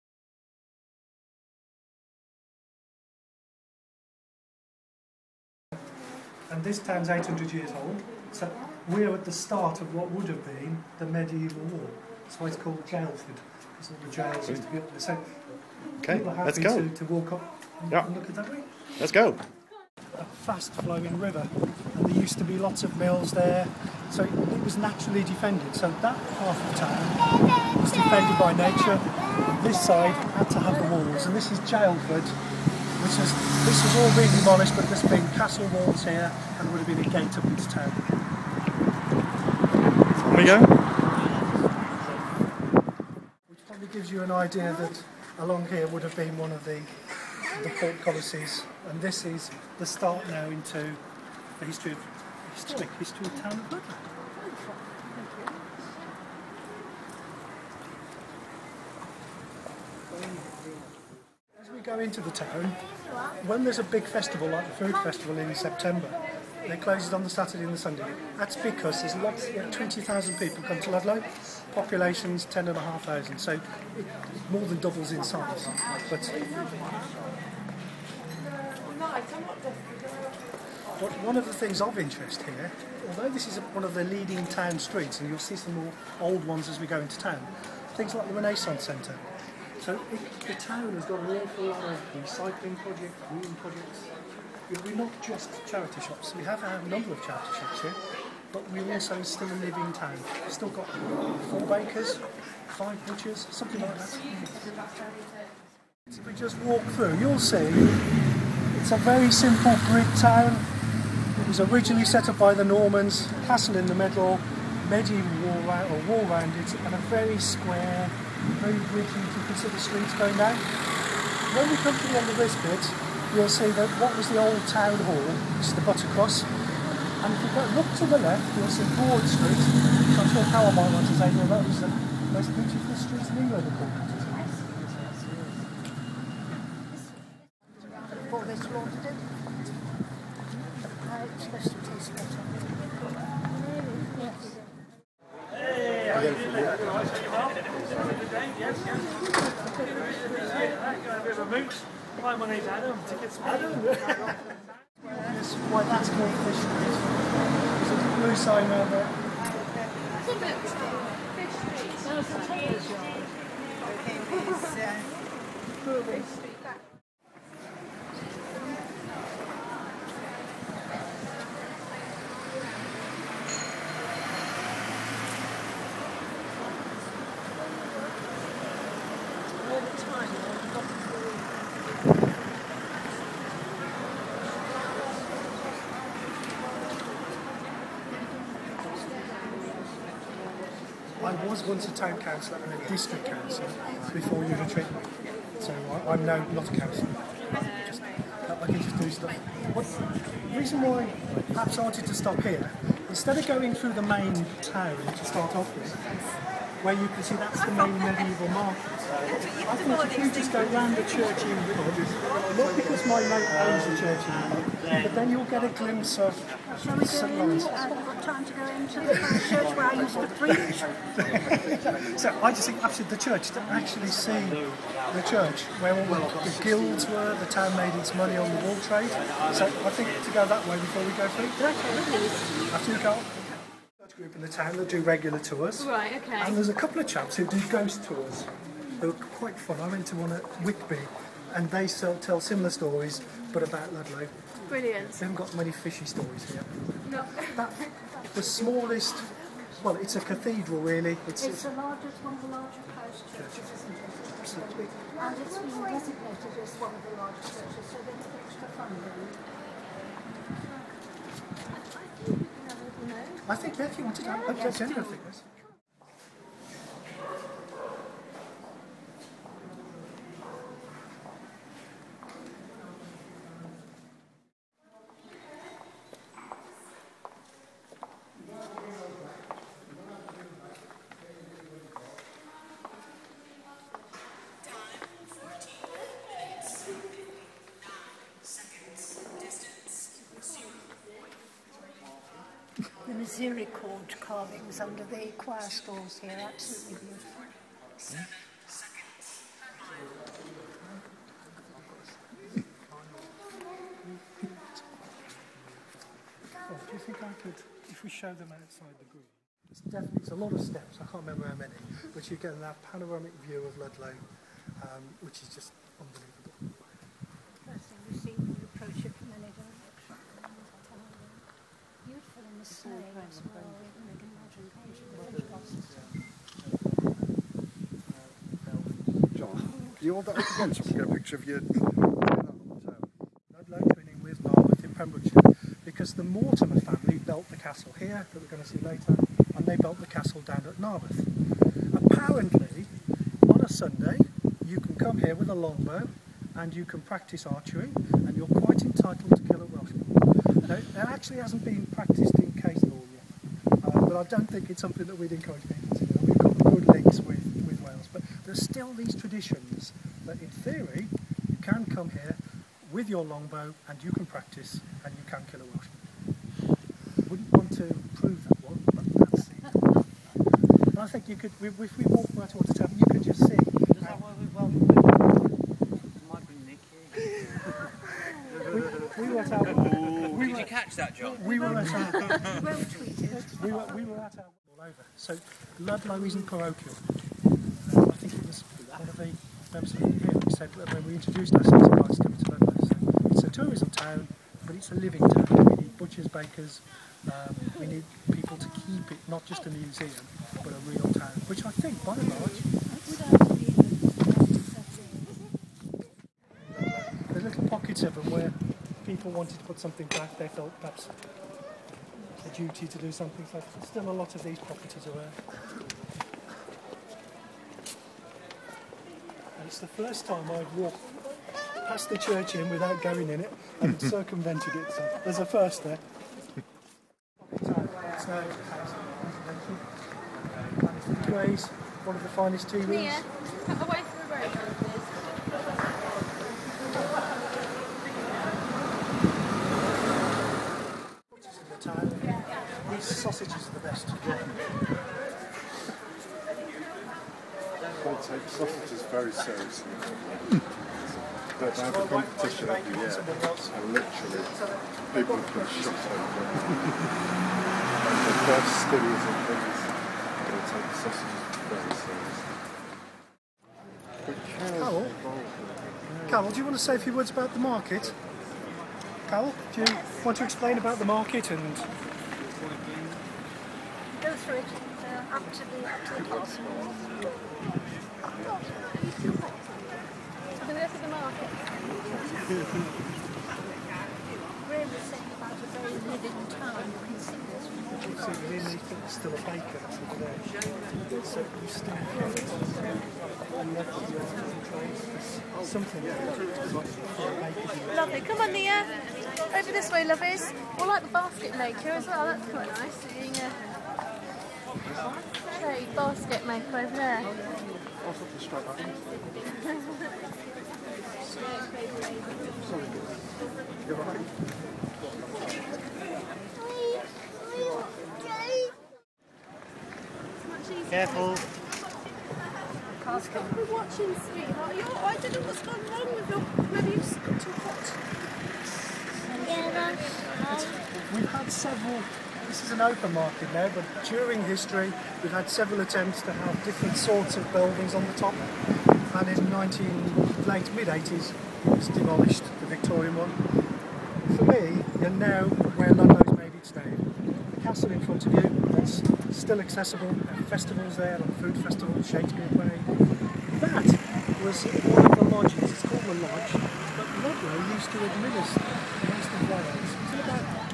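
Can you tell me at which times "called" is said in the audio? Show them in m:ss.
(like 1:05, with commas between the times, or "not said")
0:12, 2:36, 9:15.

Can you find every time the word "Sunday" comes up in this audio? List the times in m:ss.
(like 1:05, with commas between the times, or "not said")
1:07, 5:43.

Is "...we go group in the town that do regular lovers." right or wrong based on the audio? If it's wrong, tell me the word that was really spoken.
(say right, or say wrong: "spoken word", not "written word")
wrong: "tours", not "lovers".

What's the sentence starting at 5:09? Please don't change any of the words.
It's definitely it's a lot of steps.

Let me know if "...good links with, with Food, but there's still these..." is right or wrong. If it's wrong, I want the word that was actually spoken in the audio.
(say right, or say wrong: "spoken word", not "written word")
wrong: "Wales", not "Food".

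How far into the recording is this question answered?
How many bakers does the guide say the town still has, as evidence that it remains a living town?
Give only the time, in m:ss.
1:41.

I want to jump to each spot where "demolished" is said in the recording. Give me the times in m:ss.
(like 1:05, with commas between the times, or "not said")
0:34, 9:01.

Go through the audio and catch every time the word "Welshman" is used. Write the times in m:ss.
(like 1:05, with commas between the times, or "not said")
5:49, 6:05.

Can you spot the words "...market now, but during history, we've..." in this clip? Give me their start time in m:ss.
8:53.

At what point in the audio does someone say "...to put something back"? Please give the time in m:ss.
6:49.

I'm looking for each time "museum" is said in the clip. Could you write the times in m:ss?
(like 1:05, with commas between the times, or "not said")
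6:39.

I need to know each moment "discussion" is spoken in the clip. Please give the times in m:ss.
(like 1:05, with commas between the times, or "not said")
not said.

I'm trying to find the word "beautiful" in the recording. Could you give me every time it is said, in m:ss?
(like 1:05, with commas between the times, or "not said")
2:12, 4:57.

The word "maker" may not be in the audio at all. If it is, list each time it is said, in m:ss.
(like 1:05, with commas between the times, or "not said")
8:21, 8:26.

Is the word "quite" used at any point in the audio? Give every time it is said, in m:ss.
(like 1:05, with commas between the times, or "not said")
3:59, 5:48, 8:22.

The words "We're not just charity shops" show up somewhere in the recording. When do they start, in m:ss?
1:34.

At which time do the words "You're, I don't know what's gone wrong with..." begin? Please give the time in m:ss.
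8:44.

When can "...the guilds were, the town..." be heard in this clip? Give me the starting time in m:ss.
3:46.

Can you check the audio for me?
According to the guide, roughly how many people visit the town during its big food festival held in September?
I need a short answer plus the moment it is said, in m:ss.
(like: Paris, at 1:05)
20,000, at 1:09.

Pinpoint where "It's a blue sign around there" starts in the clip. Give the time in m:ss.
2:37.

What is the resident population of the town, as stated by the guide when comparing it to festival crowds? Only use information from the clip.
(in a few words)
10,500.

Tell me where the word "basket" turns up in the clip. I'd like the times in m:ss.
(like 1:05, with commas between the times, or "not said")
8:21, 8:25.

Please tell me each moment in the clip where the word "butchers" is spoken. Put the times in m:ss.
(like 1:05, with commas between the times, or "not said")
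1:43, 6:35.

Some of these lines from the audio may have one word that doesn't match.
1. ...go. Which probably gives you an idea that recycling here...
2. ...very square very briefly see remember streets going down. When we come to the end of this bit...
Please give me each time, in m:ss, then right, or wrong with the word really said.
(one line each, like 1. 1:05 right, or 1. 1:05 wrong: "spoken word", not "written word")
1. 0:40 wrong: "along", not "recycling"
2. 1:57 wrong: "consider", not "remember".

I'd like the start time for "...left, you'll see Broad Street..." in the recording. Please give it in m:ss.
2:08.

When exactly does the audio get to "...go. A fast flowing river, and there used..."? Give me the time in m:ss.
0:19.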